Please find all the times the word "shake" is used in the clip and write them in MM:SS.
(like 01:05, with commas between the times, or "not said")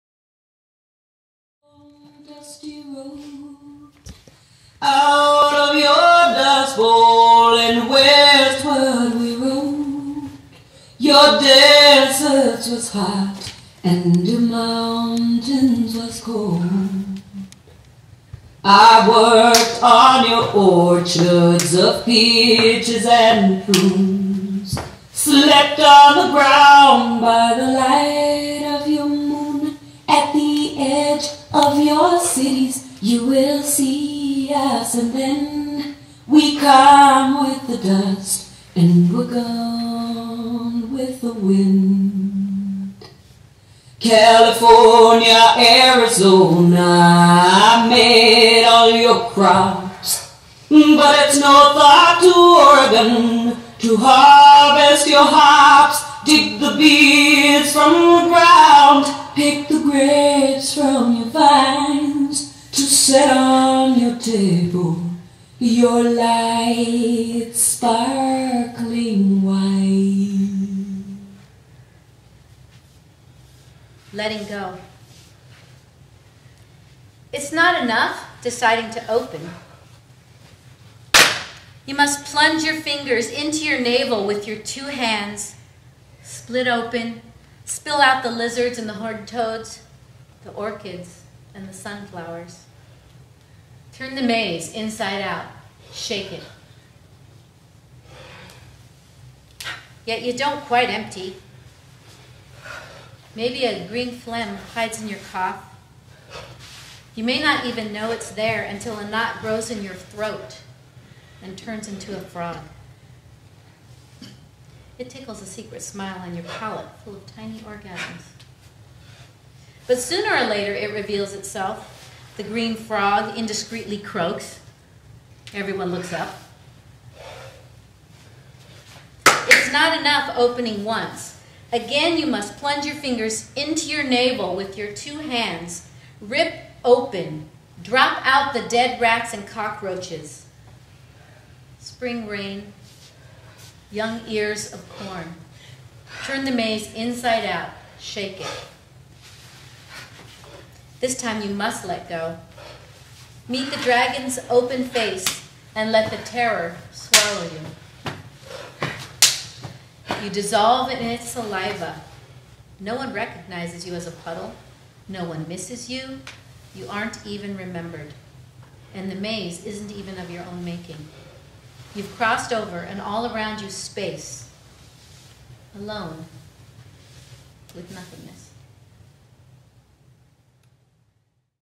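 01:35, 02:27.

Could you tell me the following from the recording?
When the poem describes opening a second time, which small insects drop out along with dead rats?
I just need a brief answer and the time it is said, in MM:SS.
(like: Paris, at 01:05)
cockroaches, at 02:19.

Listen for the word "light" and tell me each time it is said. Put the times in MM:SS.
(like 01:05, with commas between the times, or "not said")
00:27, 01:06.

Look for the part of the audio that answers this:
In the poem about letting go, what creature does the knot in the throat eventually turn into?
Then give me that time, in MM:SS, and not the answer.
01:52.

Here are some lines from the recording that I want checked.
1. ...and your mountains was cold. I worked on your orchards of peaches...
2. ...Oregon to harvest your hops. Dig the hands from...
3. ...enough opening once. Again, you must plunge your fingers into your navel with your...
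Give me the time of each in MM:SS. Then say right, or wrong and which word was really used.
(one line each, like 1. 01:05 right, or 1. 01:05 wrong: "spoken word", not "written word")
1. 00:13 right
2. 00:52 wrong: "beads", not "hands"
3. 02:09 right.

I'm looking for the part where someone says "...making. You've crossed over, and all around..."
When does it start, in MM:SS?
02:50.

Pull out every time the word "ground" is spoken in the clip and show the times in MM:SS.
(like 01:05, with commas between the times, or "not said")
00:26, 00:58.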